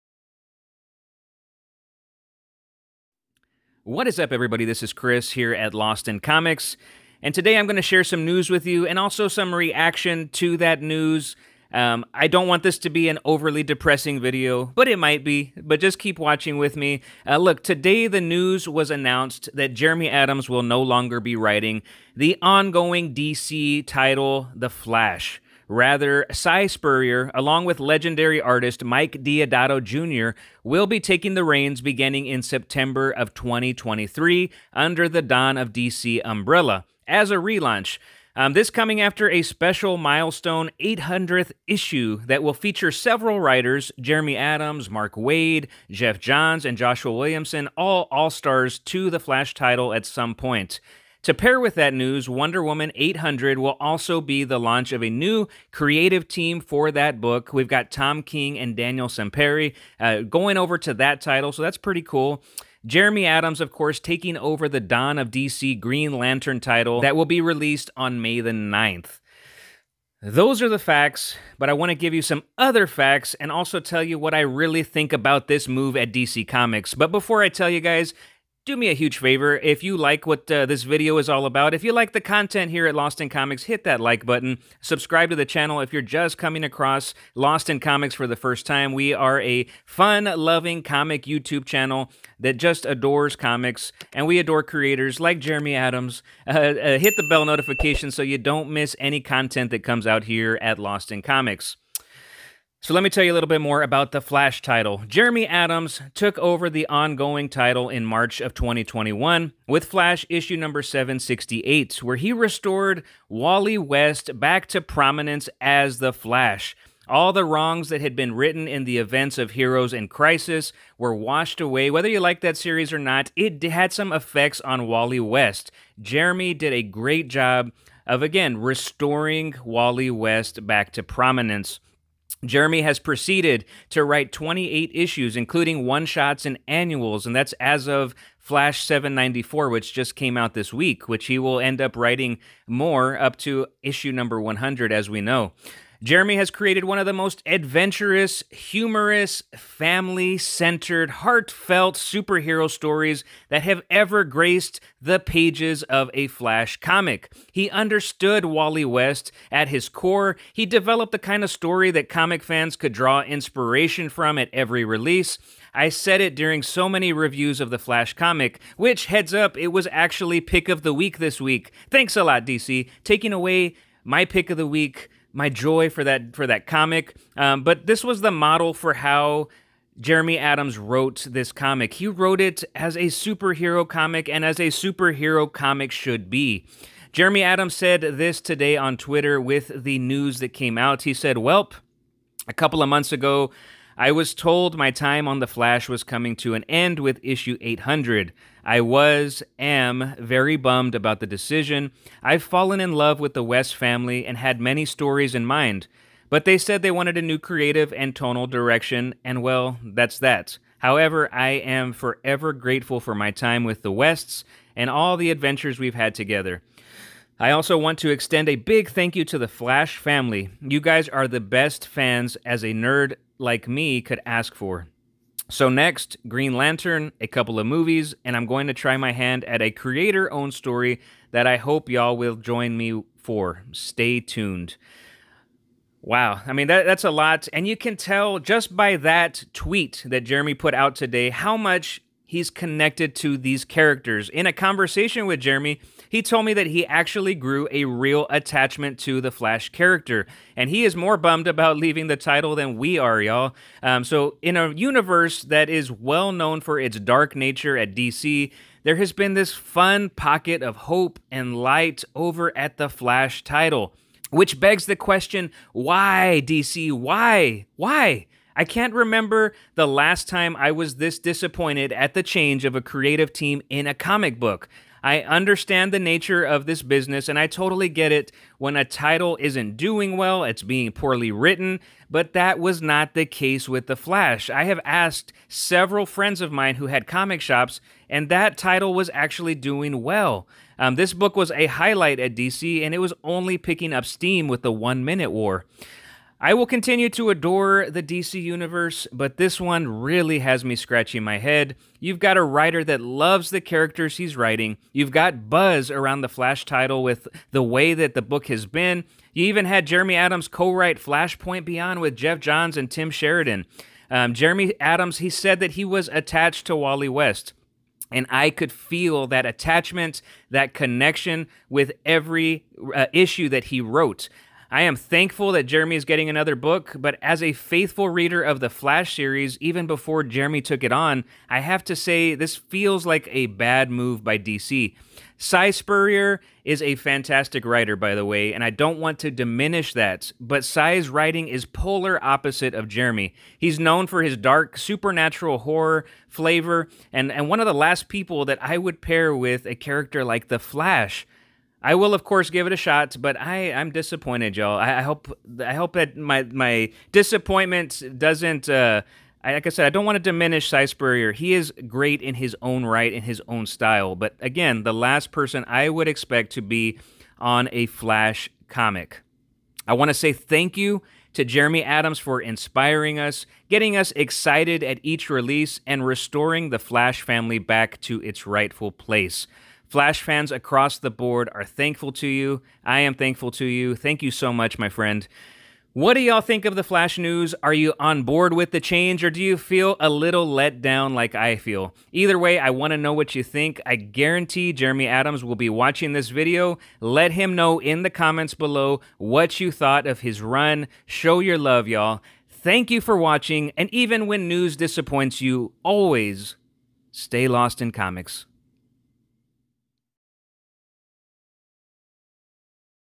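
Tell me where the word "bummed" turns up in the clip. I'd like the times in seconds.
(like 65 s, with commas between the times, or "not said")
200 s, 251 s.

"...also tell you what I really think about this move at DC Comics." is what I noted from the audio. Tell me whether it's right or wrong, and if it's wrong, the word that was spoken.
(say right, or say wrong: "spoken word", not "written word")
right.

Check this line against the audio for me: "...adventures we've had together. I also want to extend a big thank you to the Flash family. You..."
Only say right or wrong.
right.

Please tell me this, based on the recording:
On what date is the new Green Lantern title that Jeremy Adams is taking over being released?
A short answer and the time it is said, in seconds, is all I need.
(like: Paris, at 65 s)
May 9, at 68 s.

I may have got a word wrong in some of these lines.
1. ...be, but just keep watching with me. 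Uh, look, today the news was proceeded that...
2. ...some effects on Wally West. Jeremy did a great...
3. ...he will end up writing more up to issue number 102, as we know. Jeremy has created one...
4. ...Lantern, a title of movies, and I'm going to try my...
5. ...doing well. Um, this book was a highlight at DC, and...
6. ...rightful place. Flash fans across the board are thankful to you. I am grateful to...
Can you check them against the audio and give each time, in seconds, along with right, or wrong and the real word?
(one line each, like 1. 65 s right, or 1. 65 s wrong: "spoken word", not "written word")
1. 15 s wrong: "announced", not "proceeded"
2. 123 s right
3. 141 s wrong: "100", not "102"
4. 226 s wrong: "couple", not "title"
5. 289 s right
6. 378 s wrong: "thankful", not "grateful".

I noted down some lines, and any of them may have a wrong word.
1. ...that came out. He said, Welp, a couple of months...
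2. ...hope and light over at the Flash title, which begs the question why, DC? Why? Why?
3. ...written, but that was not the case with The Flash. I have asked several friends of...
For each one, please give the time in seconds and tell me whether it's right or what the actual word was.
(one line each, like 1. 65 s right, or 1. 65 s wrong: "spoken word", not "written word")
1. 190 s right
2. 260 s right
3. 281 s right.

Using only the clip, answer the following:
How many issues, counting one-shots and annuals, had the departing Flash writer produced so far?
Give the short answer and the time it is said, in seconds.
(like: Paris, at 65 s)
28, at 134 s.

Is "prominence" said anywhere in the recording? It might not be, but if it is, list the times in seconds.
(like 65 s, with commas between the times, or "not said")
114 s, 131 s.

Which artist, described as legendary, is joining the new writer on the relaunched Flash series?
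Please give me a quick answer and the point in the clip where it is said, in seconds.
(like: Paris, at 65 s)
Mike Deodato Jr., at 28 s.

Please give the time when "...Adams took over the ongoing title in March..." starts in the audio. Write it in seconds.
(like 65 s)
105 s.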